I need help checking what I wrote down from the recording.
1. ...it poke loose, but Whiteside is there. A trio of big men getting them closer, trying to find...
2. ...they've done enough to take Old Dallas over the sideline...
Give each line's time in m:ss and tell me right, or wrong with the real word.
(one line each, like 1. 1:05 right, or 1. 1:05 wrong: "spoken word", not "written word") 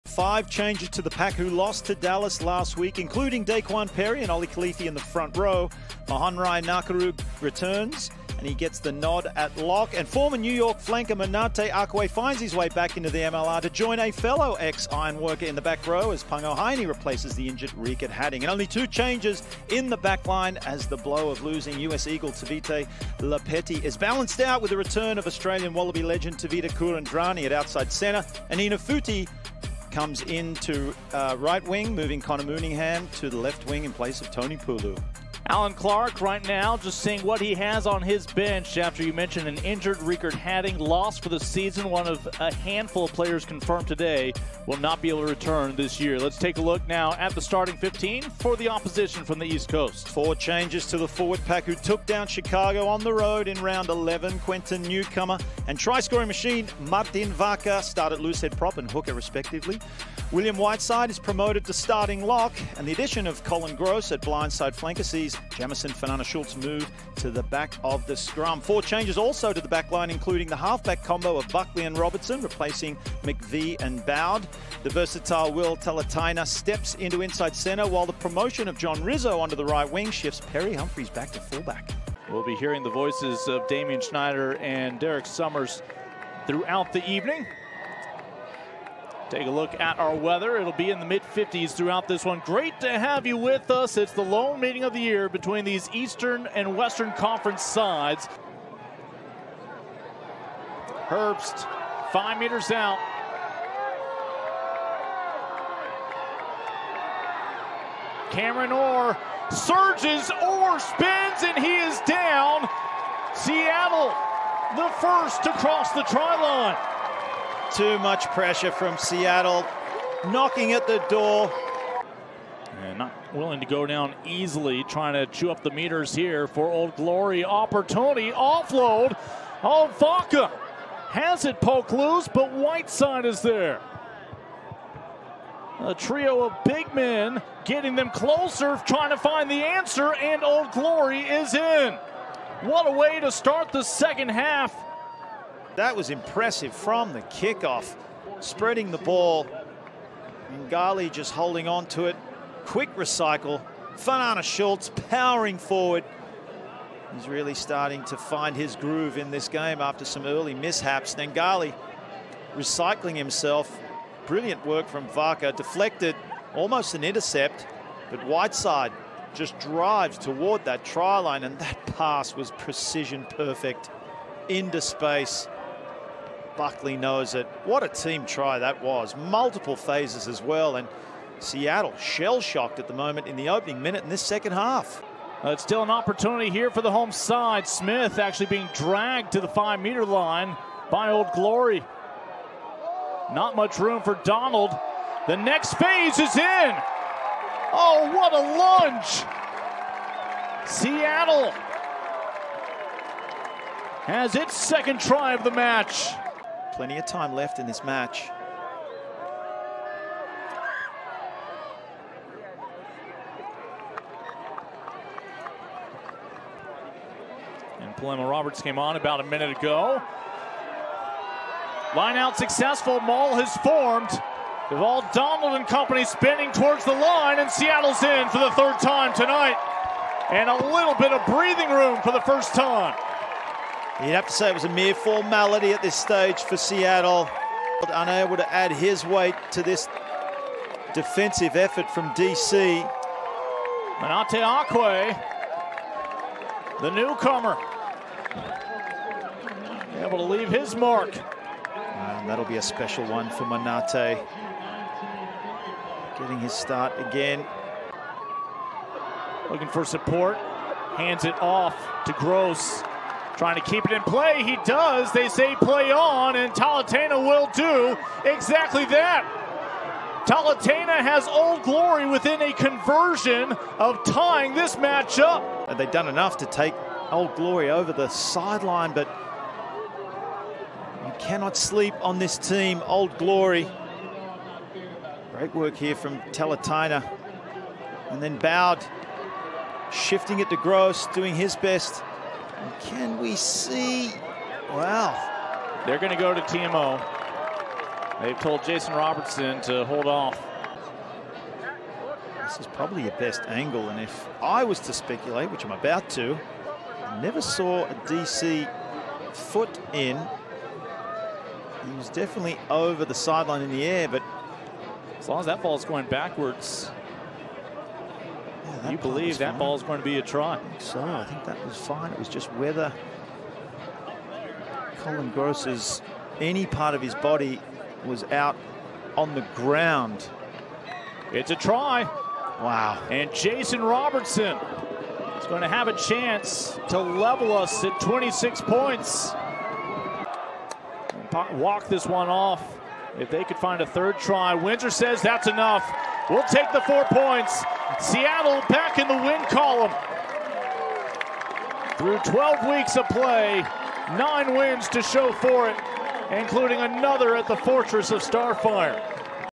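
1. 2:11 right
2. 4:35 wrong: "Glory", not "Dallas".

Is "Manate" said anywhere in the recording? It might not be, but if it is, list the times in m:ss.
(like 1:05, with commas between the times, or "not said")
0:11, 4:03, 4:13.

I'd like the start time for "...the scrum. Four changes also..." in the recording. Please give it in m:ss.
1:08.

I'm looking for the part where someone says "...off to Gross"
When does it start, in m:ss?
4:21.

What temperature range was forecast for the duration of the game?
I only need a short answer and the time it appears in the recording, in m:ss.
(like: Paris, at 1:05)
mid 50s, at 1:31.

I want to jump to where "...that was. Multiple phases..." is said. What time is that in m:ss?
2:58.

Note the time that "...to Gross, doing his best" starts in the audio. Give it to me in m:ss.
4:50.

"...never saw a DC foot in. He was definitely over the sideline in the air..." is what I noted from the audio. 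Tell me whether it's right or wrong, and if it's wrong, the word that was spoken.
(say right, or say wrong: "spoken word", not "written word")
right.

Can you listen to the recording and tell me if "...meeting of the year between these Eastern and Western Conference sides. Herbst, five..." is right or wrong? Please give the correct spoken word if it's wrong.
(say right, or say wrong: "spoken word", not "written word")
right.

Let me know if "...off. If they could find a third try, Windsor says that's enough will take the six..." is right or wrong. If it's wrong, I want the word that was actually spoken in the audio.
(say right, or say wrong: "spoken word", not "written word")
wrong: "four", not "six".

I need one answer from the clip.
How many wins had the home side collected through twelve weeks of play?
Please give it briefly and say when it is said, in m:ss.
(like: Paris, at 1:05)
9, at 5:54.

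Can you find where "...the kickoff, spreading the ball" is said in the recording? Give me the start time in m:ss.
2:27.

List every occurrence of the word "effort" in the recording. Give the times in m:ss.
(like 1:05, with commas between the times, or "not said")
4:01.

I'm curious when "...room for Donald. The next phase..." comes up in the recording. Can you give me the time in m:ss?
3:13.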